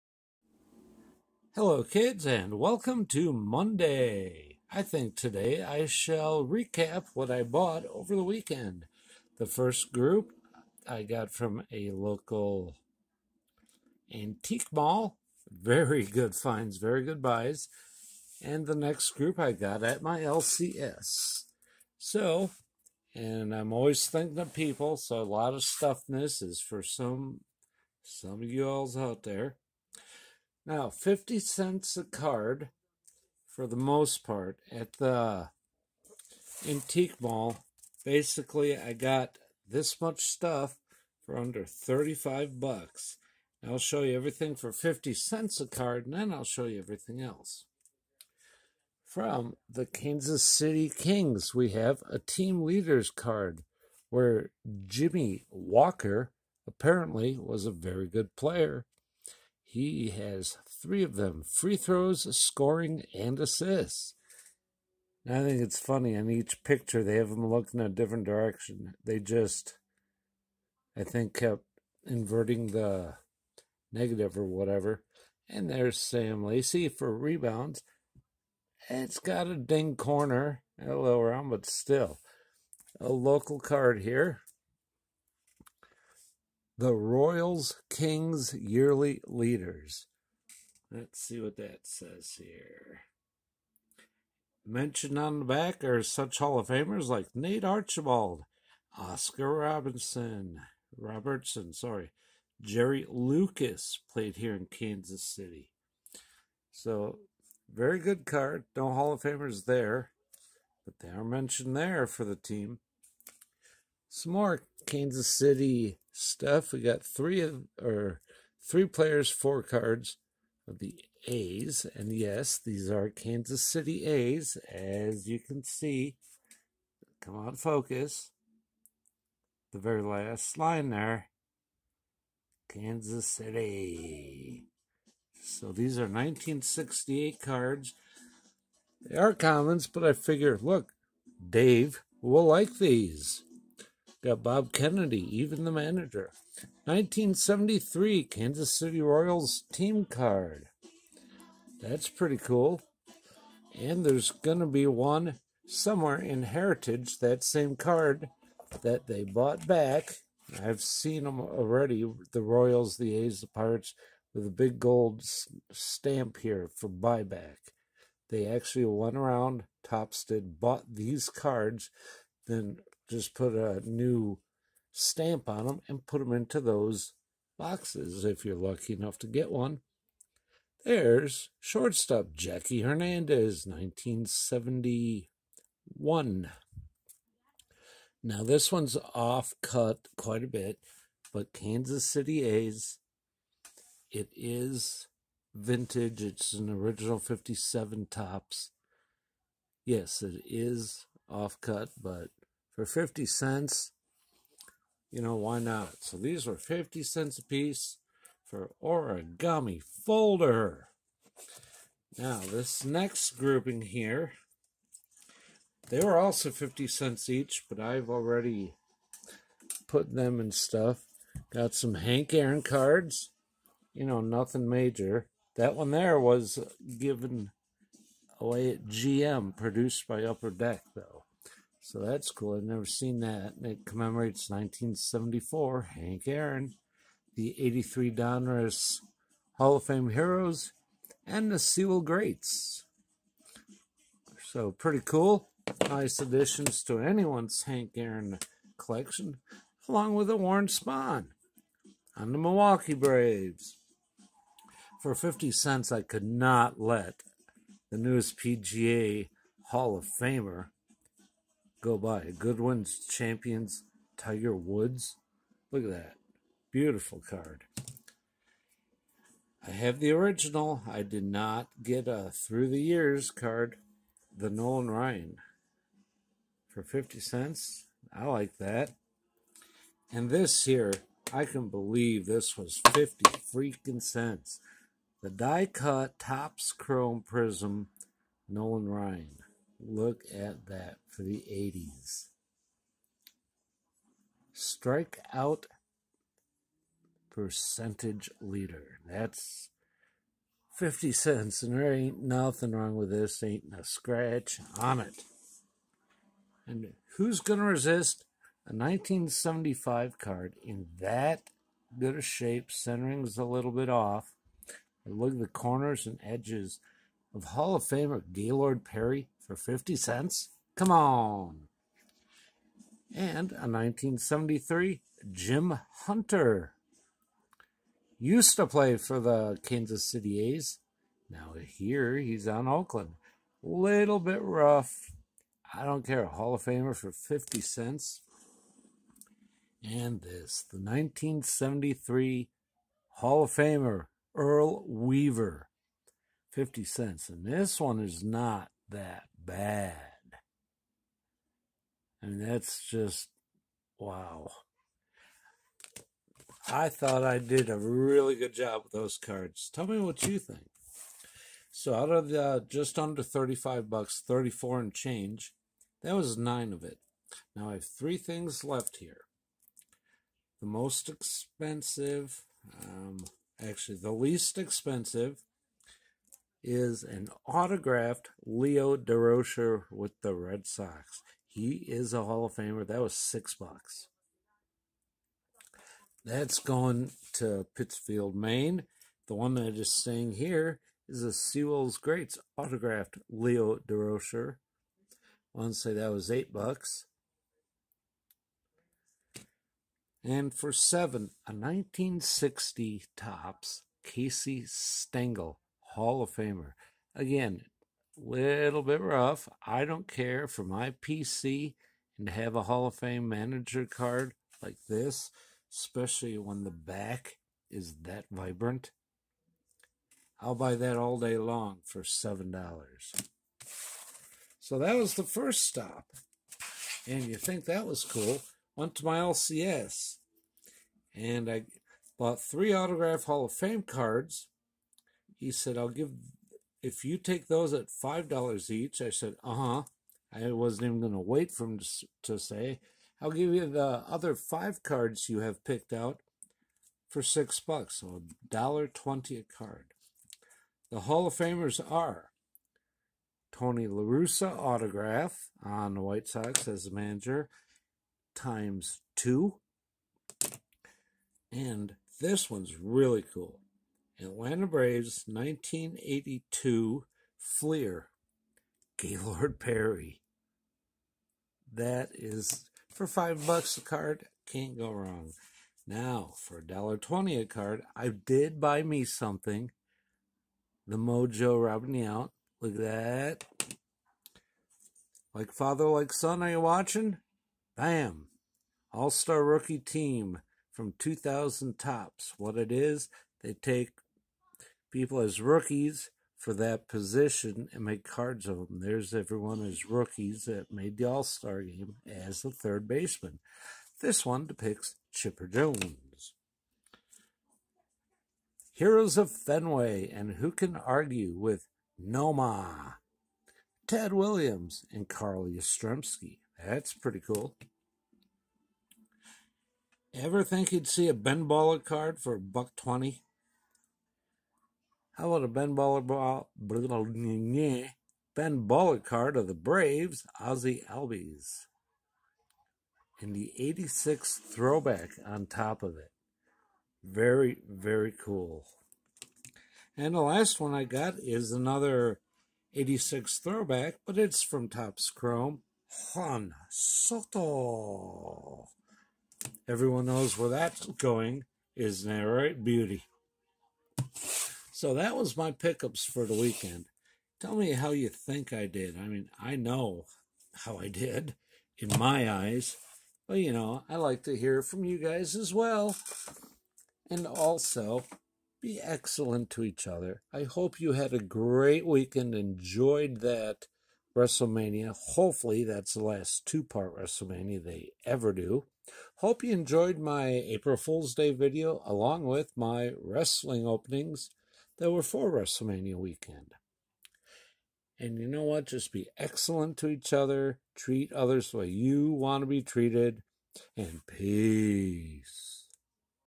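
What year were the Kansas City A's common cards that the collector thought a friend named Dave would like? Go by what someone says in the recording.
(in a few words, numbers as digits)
1968.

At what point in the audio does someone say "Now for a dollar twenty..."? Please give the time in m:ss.
7:55.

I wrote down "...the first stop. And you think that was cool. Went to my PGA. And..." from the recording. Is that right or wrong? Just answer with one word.
wrong.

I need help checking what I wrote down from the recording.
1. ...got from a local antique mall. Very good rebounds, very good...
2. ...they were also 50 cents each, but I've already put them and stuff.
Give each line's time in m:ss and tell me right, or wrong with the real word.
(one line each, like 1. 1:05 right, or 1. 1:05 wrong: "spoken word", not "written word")
1. 0:11 wrong: "finds", not "rebounds"
2. 3:35 right.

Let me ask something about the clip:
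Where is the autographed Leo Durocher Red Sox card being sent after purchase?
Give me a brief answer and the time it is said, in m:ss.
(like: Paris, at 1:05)
Pittsfield, Maine, at 6:27.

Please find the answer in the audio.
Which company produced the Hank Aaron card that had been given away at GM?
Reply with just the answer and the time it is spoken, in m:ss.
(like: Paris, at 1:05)
Upper Deck, at 3:50.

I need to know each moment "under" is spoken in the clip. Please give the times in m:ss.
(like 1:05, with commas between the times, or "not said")
0:41, 6:02.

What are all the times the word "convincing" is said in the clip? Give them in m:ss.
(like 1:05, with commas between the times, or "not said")
not said.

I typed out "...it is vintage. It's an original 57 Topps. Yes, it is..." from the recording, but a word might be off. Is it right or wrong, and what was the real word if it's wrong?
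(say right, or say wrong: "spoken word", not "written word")
right.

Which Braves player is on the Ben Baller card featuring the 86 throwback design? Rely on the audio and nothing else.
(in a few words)
Ozzie Albies.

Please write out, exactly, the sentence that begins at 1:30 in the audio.
Let's see what that says here.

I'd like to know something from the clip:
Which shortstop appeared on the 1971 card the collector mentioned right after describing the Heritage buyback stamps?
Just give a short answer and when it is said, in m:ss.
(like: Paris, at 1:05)
Jackie Hernandez, at 3:02.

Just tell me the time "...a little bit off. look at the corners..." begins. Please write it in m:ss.
5:13.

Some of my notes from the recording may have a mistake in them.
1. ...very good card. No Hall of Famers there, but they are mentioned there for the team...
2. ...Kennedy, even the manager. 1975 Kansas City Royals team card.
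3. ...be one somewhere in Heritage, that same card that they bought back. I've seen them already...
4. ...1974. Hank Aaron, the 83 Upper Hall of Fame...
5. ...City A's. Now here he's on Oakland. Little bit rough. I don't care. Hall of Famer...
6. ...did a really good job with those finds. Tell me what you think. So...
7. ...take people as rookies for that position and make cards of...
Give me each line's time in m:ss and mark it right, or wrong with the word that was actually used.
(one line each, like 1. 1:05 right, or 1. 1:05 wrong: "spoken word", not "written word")
1. 1:47 right
2. 2:24 wrong: "1973", not "1975"
3. 2:34 right
4. 3:54 wrong: "Donruss", not "Upper"
5. 5:30 right
6. 5:57 wrong: "cards", not "finds"
7. 8:13 right.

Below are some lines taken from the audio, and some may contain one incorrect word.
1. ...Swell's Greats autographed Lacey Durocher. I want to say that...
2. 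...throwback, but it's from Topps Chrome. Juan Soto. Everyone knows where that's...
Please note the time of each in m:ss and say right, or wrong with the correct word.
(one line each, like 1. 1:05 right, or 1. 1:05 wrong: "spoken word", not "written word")
1. 6:31 wrong: "Leo", not "Lacey"
2. 9:03 right.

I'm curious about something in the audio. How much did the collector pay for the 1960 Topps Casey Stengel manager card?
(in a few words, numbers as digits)
$7.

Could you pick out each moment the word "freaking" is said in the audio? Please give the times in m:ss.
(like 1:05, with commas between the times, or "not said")
4:43.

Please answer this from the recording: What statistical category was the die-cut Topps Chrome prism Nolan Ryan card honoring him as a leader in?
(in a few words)
Strike out percentage.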